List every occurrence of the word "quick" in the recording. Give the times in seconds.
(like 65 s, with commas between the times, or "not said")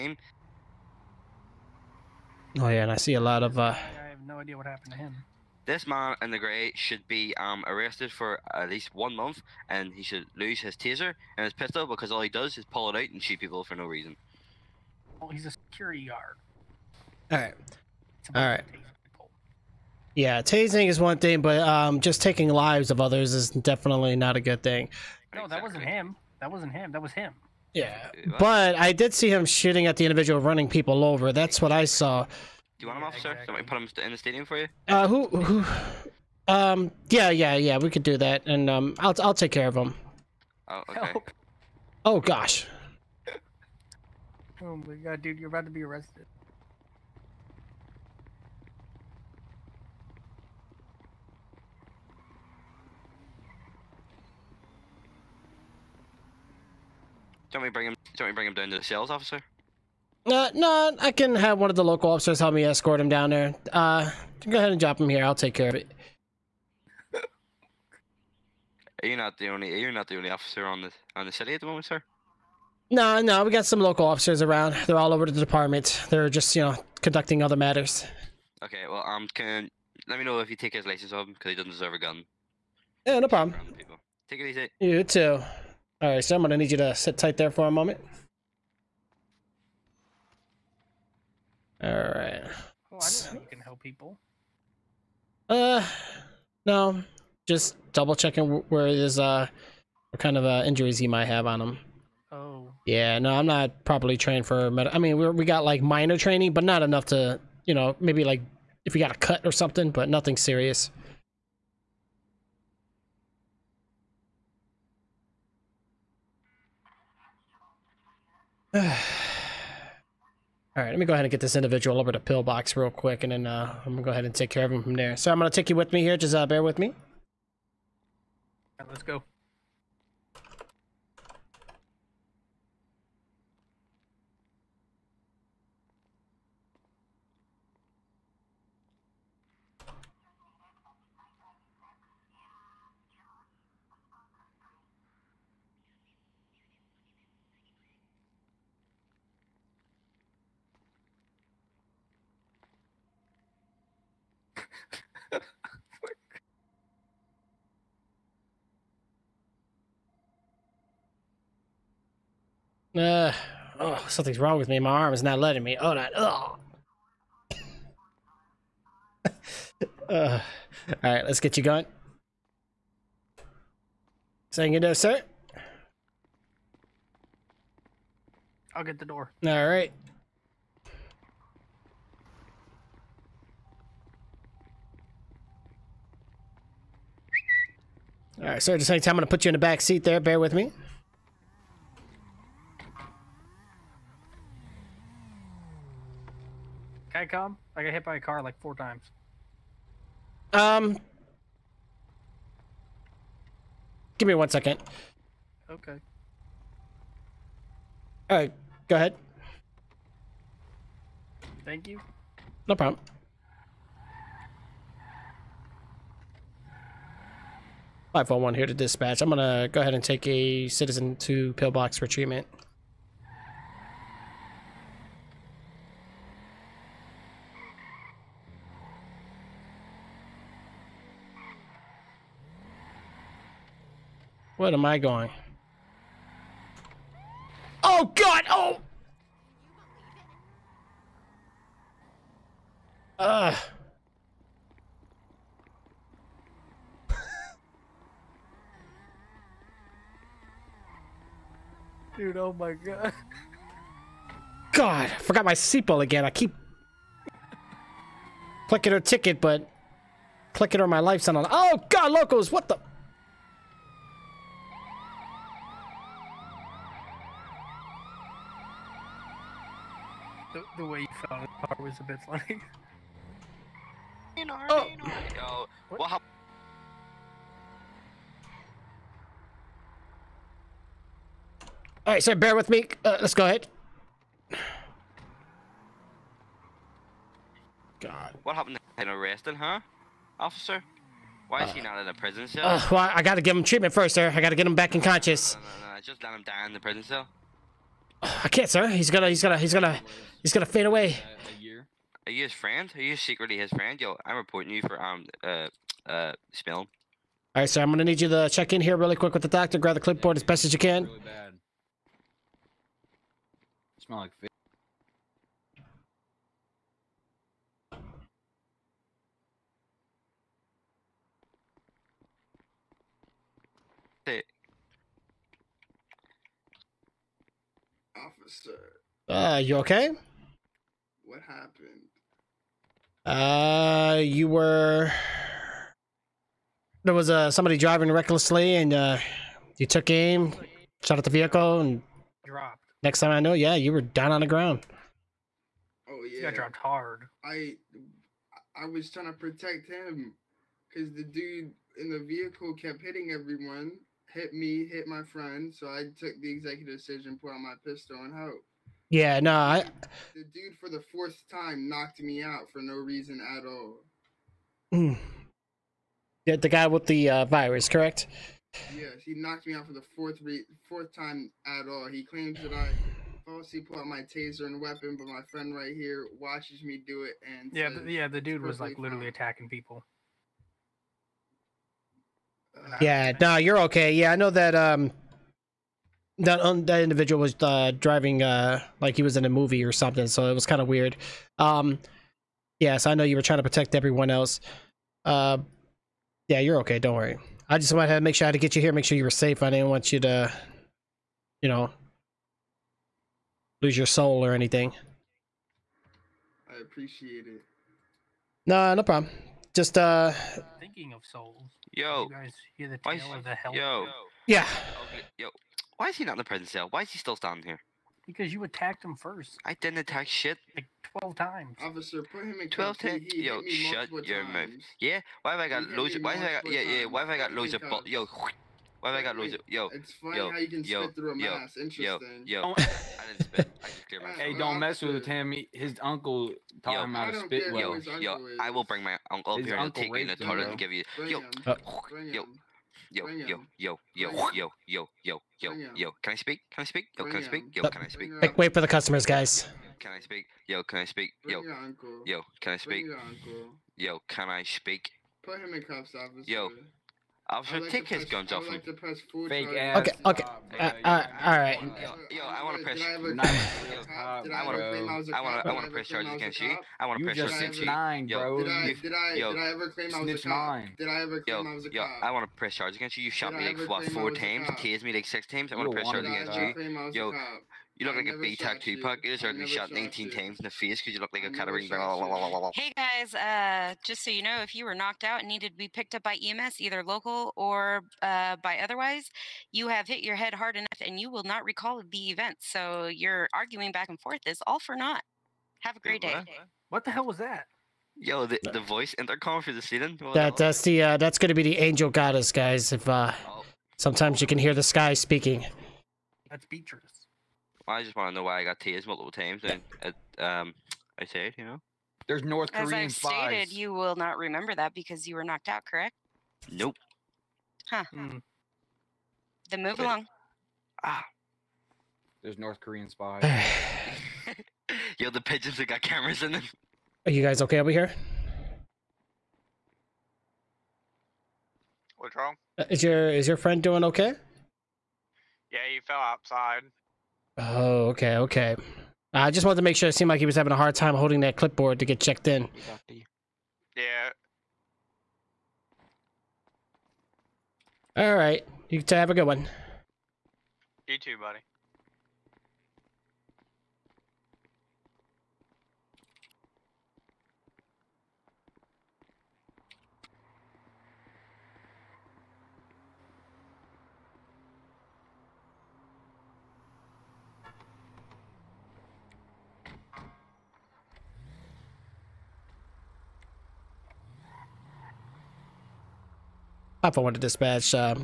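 122 s, 309 s.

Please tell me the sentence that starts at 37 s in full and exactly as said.
We could do that, and um, I'll I'll take care of him.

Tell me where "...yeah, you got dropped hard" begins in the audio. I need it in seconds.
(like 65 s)
346 s.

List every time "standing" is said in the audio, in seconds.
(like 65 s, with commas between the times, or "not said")
417 s.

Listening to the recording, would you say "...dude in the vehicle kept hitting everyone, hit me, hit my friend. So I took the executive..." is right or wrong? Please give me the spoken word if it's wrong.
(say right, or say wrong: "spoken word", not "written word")
right.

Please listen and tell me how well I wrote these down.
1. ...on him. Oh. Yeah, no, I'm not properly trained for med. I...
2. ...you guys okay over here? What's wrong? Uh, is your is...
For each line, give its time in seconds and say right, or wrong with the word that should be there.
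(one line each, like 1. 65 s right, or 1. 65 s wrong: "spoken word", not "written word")
1. 101 s right
2. 527 s right.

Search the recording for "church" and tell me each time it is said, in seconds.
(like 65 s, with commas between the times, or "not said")
not said.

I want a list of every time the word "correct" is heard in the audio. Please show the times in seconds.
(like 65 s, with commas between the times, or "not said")
367 s, 515 s.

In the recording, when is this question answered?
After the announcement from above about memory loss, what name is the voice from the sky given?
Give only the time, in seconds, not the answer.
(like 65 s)
506 s.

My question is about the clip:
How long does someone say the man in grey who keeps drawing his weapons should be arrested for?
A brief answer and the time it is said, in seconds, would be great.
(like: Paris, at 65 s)
1 month, at 8 s.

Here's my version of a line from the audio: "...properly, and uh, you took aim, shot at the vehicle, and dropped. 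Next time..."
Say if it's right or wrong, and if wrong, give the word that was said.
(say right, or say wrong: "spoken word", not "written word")
wrong: "recklessly", not "properly".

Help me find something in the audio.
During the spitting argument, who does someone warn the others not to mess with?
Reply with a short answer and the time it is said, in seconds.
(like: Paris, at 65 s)
Tammy, at 435 s.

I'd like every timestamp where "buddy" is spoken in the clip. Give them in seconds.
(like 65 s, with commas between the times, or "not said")
551 s.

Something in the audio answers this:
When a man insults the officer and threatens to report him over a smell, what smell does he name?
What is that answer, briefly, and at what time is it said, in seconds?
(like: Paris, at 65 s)
Fish, at 314 s.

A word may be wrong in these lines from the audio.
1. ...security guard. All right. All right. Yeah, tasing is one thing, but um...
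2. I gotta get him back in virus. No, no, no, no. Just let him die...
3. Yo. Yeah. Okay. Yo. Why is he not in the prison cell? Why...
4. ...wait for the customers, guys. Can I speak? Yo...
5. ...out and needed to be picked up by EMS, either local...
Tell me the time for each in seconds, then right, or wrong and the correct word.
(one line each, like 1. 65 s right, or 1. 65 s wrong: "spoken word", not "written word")
1. 15 s right
2. 294 s wrong: "conscious", not "virus"
3. 413 s right
4. 448 s right
5. 485 s right.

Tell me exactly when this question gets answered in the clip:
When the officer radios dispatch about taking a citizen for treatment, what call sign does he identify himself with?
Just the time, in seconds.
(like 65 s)
218 s.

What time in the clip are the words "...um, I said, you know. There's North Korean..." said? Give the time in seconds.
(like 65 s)
510 s.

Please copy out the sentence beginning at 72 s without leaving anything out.
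No, no, we got some local officers around.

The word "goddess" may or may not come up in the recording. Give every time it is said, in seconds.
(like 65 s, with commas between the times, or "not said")
502 s.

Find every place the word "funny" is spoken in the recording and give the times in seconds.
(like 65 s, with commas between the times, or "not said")
272 s, 430 s.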